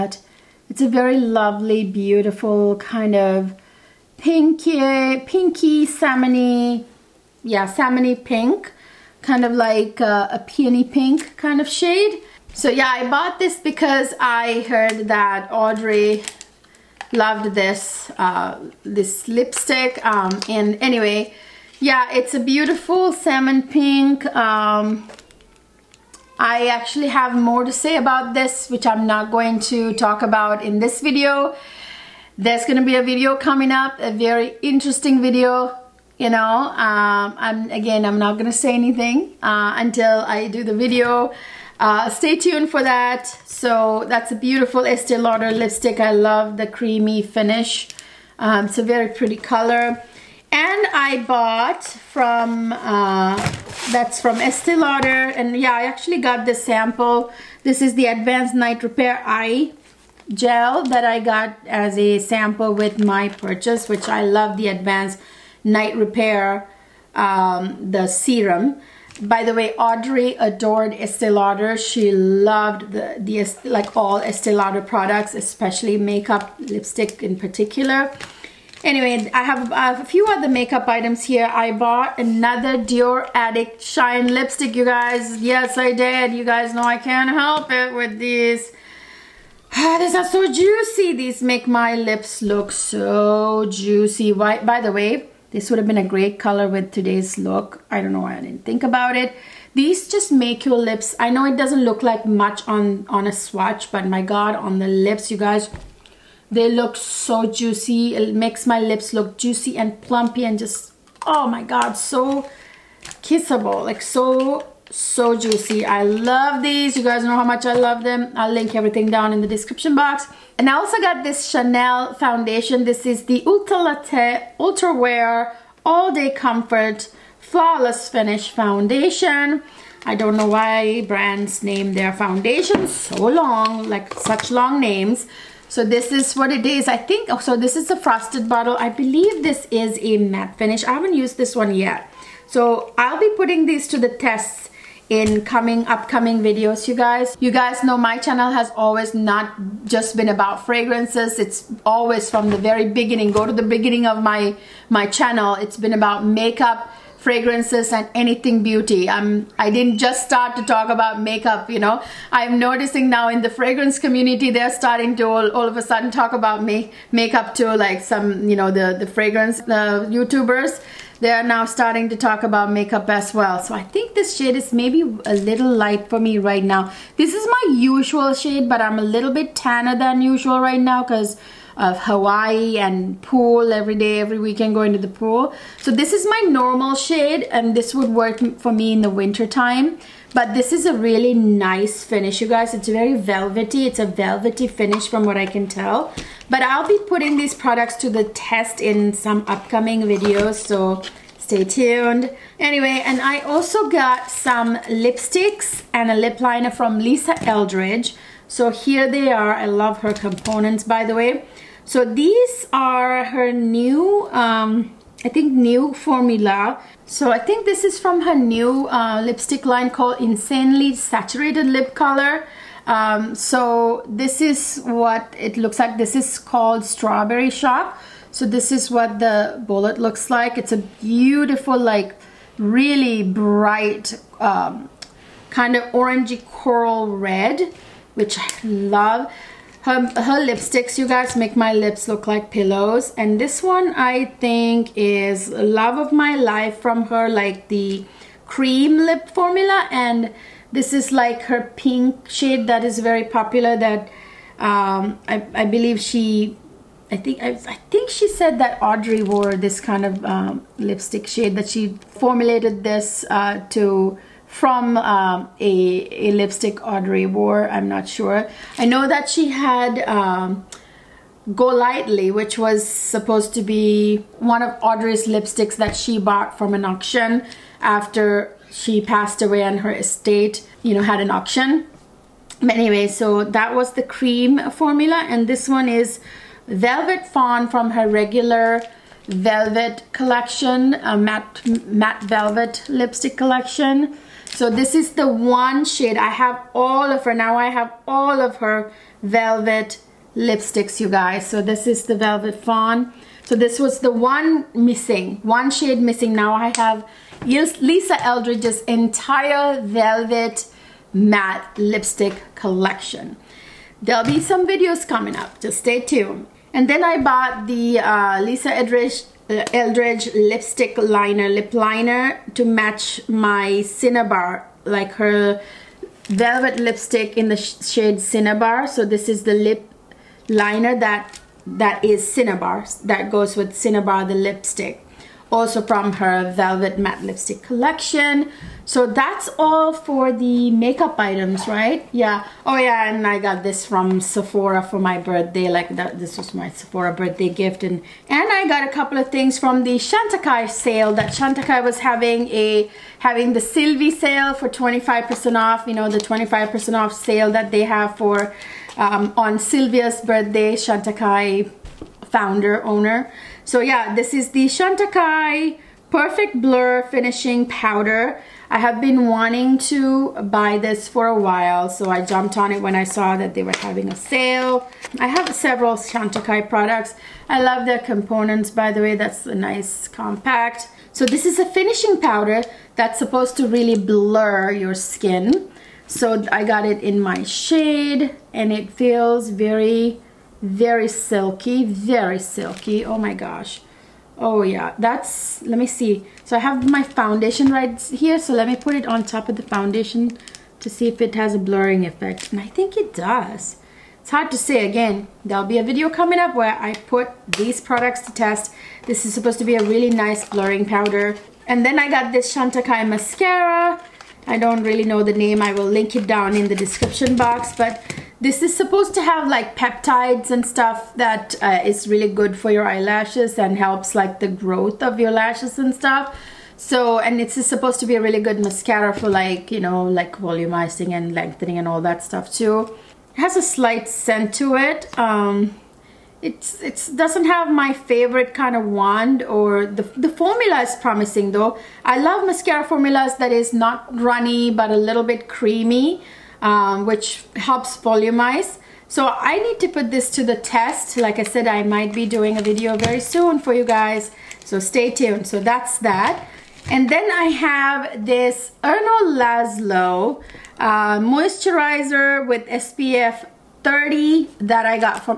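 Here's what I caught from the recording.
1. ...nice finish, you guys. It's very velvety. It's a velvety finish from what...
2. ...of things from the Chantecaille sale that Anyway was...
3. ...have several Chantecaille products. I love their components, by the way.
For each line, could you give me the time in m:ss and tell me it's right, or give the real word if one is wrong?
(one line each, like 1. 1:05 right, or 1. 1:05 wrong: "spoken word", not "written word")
1. 3:11 right
2. 5:49 wrong: "Chantecaille", not "Anyway"
3. 6:15 right.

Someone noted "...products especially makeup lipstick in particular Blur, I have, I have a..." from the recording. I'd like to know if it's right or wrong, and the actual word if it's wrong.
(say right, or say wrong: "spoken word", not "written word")
wrong: "Anyway", not "Blur".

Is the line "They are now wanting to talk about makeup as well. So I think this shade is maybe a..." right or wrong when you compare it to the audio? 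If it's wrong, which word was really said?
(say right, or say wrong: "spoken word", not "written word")
wrong: "starting", not "wanting".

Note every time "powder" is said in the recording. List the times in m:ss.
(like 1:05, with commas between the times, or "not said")
6:07, 6:22, 6:50.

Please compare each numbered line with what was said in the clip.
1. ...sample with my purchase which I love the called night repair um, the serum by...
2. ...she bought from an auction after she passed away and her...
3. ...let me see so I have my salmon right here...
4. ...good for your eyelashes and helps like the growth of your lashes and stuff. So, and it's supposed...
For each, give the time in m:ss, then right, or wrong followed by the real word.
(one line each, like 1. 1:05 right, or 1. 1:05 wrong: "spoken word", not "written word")
1. 1:02 wrong: "advanced", not "called"
2. 4:35 right
3. 6:35 wrong: "foundation", not "salmon"
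4. 7:02 right.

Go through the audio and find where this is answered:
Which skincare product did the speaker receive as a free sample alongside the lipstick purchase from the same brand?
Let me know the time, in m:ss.
0:58.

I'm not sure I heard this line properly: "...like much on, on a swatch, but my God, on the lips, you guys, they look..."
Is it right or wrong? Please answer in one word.
right.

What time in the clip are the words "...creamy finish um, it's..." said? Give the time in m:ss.
0:46.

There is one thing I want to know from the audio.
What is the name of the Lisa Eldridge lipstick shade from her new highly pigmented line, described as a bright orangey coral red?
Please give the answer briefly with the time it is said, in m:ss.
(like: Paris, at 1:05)
Strawberry Shop, at 3:46.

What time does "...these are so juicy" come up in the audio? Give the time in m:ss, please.
1:29.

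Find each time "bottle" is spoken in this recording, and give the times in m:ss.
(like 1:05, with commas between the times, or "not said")
2:18.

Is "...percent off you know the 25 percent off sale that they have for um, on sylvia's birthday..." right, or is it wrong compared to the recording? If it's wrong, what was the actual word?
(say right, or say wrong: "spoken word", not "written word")
right.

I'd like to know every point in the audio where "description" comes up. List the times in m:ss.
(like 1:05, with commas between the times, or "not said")
1:59, 6:56.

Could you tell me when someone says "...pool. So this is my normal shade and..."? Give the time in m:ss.
3:05.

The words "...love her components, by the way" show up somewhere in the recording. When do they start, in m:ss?
3:29.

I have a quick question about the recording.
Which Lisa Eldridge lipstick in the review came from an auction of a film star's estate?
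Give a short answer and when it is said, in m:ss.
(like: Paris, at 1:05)
Go Lightly, at 4:31.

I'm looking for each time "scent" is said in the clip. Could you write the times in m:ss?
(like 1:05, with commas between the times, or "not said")
7:14.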